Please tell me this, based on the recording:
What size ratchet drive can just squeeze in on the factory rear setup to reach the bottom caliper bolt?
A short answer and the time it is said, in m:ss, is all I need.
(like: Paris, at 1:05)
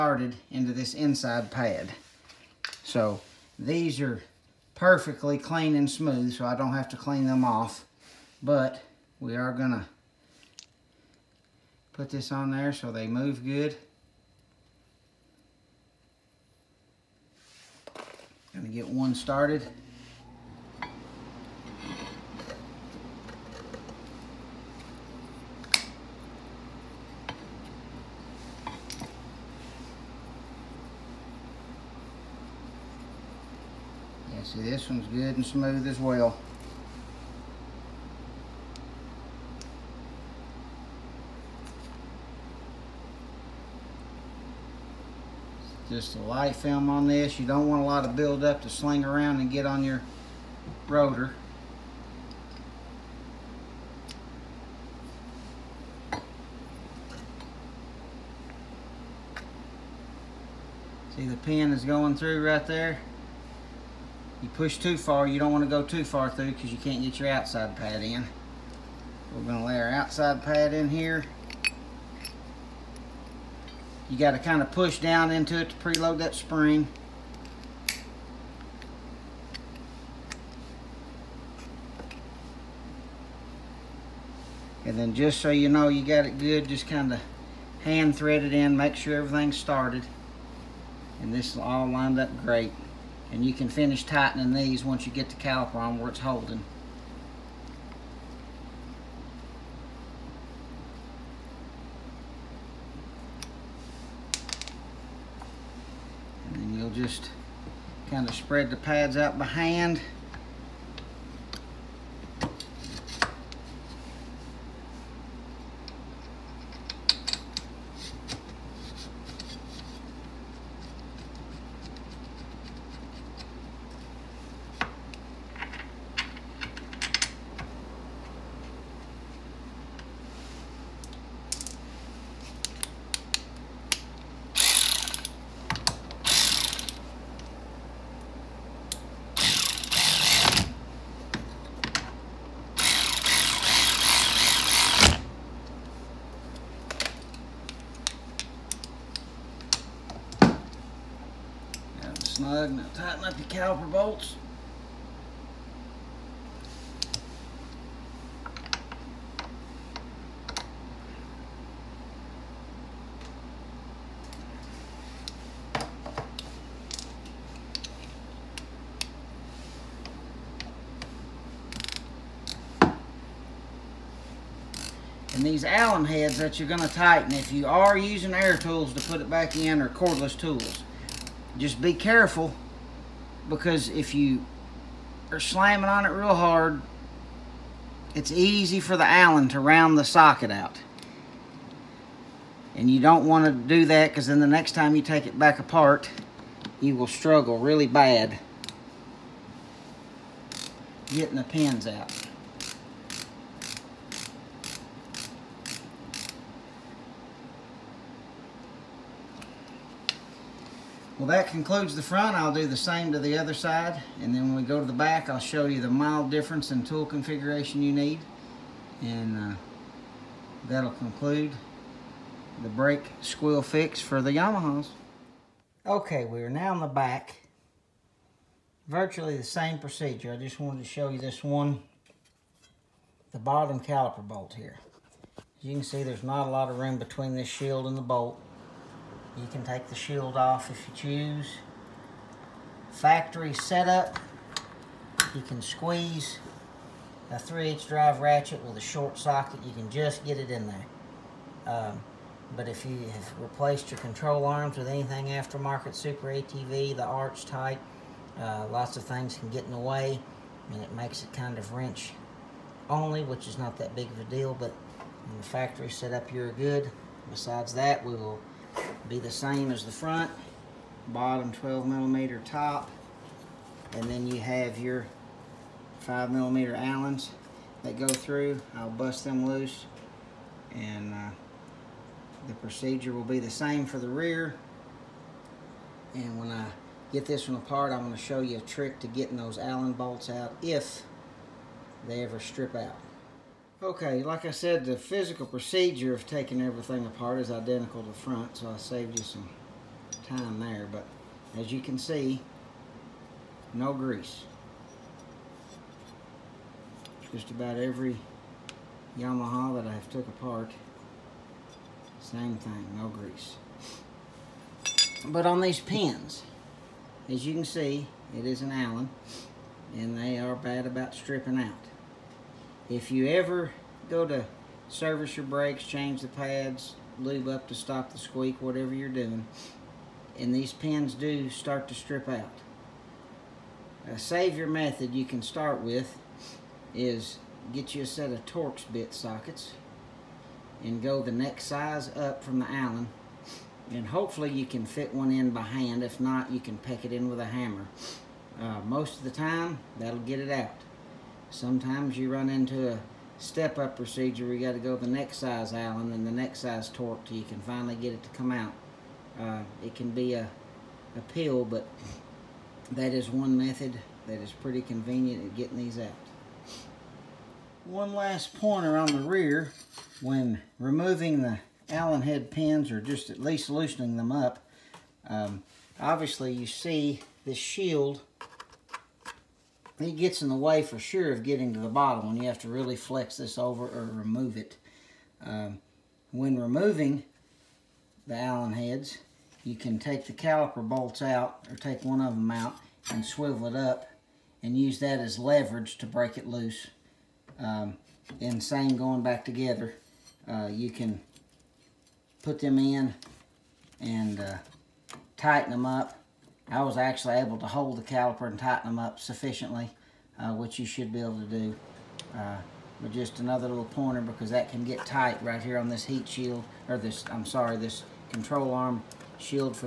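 3/8, at 4:07.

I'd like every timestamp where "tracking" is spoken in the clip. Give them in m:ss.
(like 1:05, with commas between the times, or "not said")
not said.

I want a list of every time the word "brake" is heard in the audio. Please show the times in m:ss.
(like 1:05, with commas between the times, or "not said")
3:42, 5:25.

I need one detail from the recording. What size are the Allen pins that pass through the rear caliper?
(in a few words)
5 millimeter.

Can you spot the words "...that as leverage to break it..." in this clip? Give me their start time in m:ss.
6:34.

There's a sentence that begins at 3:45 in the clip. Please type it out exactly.
Okay, we are now in the back.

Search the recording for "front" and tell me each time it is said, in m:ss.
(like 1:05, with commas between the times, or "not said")
3:32, 4:29, 4:58.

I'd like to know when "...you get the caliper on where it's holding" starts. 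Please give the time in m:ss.
1:35.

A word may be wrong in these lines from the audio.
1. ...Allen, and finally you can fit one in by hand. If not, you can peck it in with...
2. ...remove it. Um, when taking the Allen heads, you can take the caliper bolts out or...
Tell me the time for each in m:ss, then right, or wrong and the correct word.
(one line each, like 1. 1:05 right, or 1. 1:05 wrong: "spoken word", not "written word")
1. 5:42 wrong: "hopefully", not "finally"
2. 6:24 wrong: "removing", not "taking".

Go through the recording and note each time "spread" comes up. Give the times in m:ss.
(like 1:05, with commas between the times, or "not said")
1:48.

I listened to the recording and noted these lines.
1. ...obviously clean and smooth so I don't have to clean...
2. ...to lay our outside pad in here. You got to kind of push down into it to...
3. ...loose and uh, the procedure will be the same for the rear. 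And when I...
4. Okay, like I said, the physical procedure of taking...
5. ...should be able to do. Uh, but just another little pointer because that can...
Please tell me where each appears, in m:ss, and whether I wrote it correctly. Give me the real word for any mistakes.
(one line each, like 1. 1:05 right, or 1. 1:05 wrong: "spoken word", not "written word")
1. 0:04 wrong: "perfectly", not "obviously"
2. 1:09 right
3. 4:39 right
4. 4:53 right
5. 6:50 right.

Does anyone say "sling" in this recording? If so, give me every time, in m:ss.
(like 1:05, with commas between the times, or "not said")
0:48.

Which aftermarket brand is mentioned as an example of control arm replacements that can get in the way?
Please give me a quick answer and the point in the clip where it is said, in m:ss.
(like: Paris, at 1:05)
Super ATV, at 4:15.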